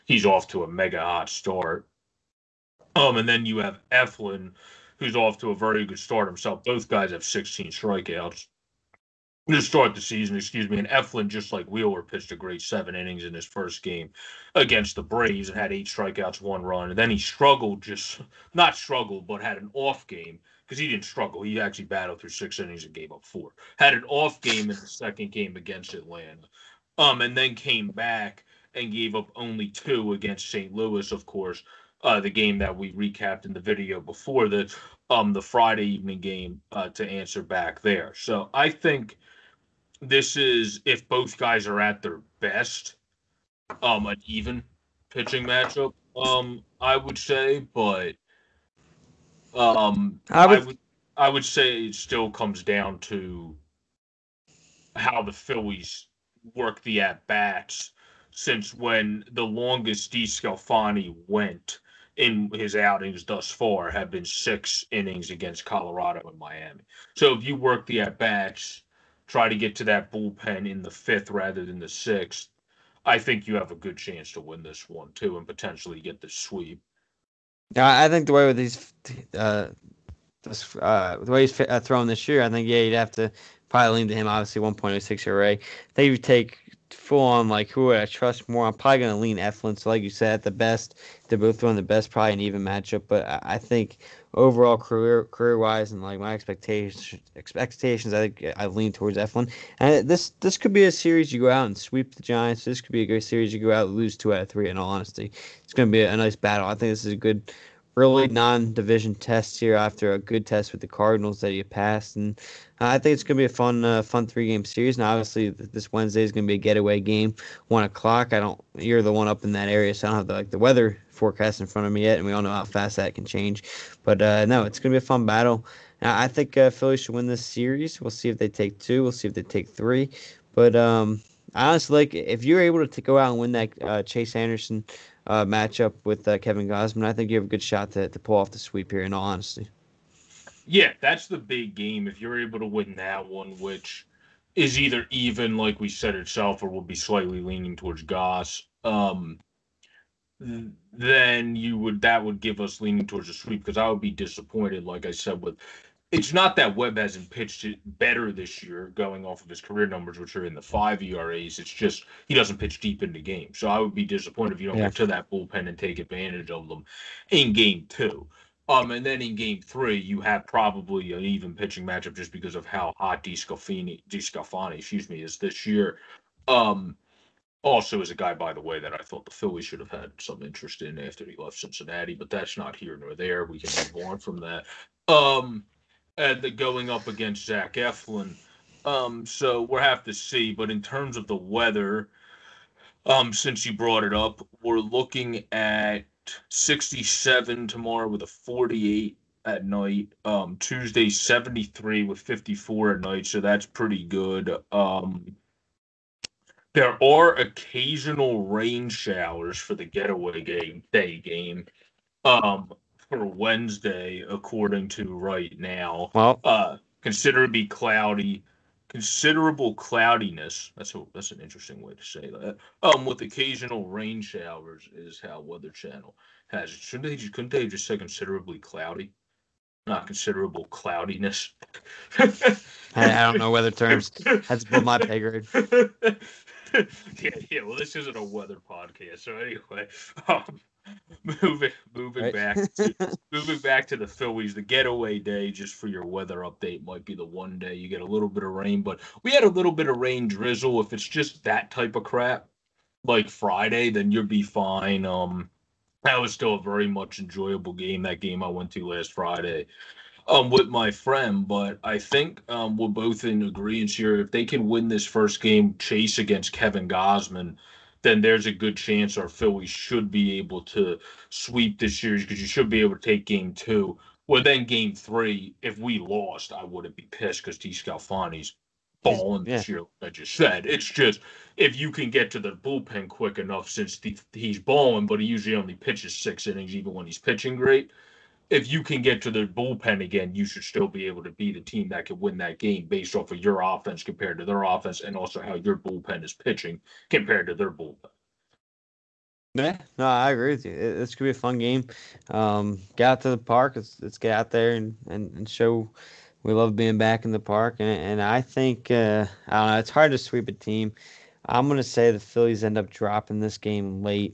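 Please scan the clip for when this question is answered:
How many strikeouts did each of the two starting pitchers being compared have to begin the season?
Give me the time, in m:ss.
0:07.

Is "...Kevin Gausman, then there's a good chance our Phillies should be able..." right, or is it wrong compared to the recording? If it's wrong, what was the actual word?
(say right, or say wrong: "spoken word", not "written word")
right.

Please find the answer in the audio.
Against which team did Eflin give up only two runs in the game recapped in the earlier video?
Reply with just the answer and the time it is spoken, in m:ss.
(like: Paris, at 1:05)
St. Louis, at 0:30.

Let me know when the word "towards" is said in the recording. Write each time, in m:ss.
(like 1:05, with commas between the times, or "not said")
1:38, 2:27, 2:33.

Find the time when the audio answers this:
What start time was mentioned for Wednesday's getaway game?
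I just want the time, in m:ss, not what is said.
1:57.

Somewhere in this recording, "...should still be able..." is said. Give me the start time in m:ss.
4:50.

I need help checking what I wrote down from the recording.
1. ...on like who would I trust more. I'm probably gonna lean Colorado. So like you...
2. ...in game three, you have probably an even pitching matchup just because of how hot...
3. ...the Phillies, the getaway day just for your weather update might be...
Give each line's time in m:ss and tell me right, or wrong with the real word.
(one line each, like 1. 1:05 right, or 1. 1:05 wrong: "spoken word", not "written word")
1. 1:27 wrong: "Eflin", not "Colorado"
2. 2:49 right
3. 4:03 right.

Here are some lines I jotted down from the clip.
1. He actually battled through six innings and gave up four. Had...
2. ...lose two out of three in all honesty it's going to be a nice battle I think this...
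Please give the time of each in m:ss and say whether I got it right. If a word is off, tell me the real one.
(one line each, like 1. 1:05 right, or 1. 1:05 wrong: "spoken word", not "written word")
1. 0:21 right
2. 1:43 right.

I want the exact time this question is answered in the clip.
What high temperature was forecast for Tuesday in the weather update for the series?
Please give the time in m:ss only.
3:21.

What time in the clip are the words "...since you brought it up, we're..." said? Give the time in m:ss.
3:13.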